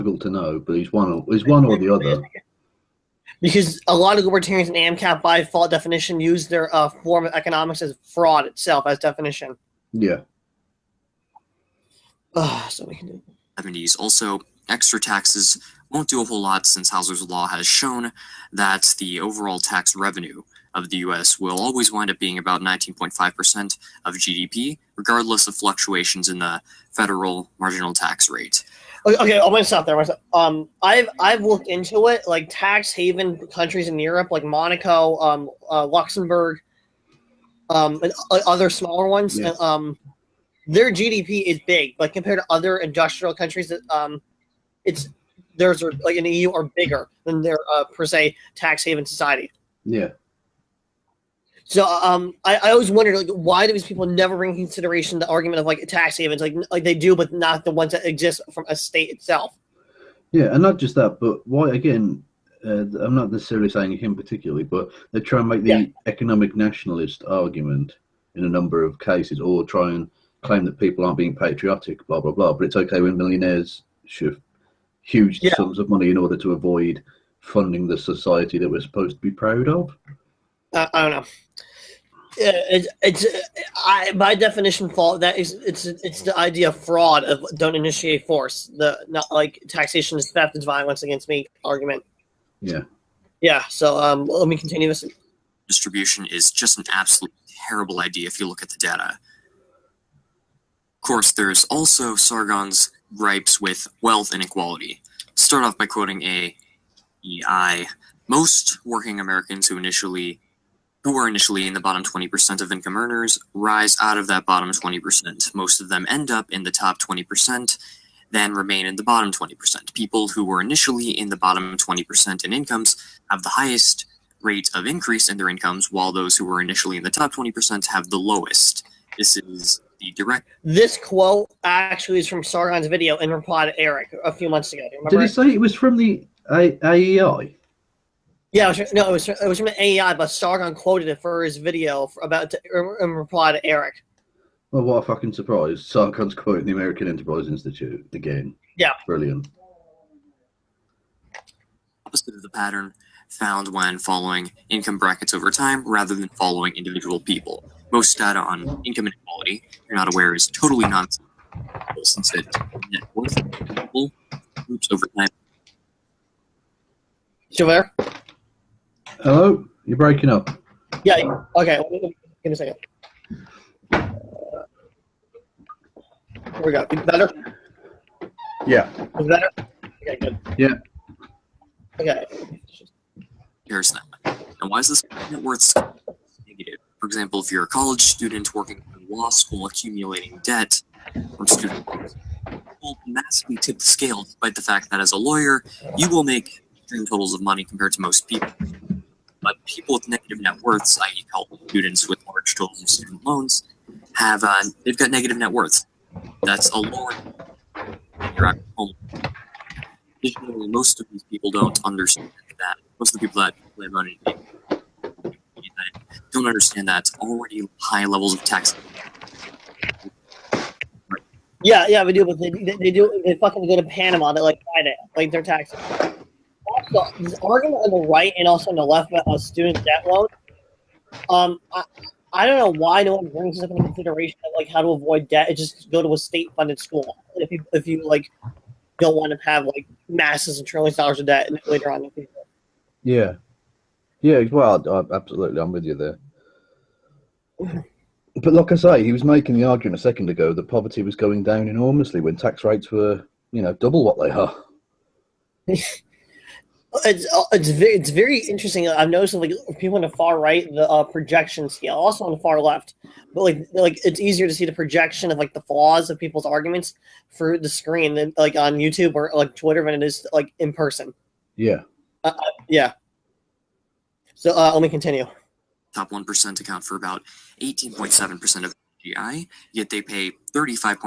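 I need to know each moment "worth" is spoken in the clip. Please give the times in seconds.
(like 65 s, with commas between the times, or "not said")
163 s, 185 s, 200 s, 205 s.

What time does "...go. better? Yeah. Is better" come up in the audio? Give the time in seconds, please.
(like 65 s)
176 s.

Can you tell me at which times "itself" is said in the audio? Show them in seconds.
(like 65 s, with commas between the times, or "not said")
8 s, 59 s.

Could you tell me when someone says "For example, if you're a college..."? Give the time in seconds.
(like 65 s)
186 s.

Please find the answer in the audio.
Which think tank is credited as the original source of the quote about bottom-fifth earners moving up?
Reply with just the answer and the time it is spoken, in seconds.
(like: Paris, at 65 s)
American Enterprise Institute, at 146 s.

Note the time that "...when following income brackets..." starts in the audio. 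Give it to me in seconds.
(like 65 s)
153 s.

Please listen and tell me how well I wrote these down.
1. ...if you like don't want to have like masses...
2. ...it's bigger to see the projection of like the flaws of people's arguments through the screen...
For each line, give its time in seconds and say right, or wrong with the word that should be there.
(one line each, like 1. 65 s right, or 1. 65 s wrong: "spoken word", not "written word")
1. 237 s right
2. 264 s wrong: "easier", not "bigger".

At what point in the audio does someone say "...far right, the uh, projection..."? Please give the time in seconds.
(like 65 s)
260 s.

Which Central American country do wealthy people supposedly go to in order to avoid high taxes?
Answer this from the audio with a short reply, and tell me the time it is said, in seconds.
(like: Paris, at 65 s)
Panama, at 223 s.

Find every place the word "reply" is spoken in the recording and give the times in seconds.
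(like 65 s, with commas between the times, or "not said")
133 s, 143 s.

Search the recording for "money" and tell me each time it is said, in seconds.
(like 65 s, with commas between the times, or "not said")
75 s, 197 s.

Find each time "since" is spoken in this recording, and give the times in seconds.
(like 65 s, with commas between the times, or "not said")
16 s, 162 s.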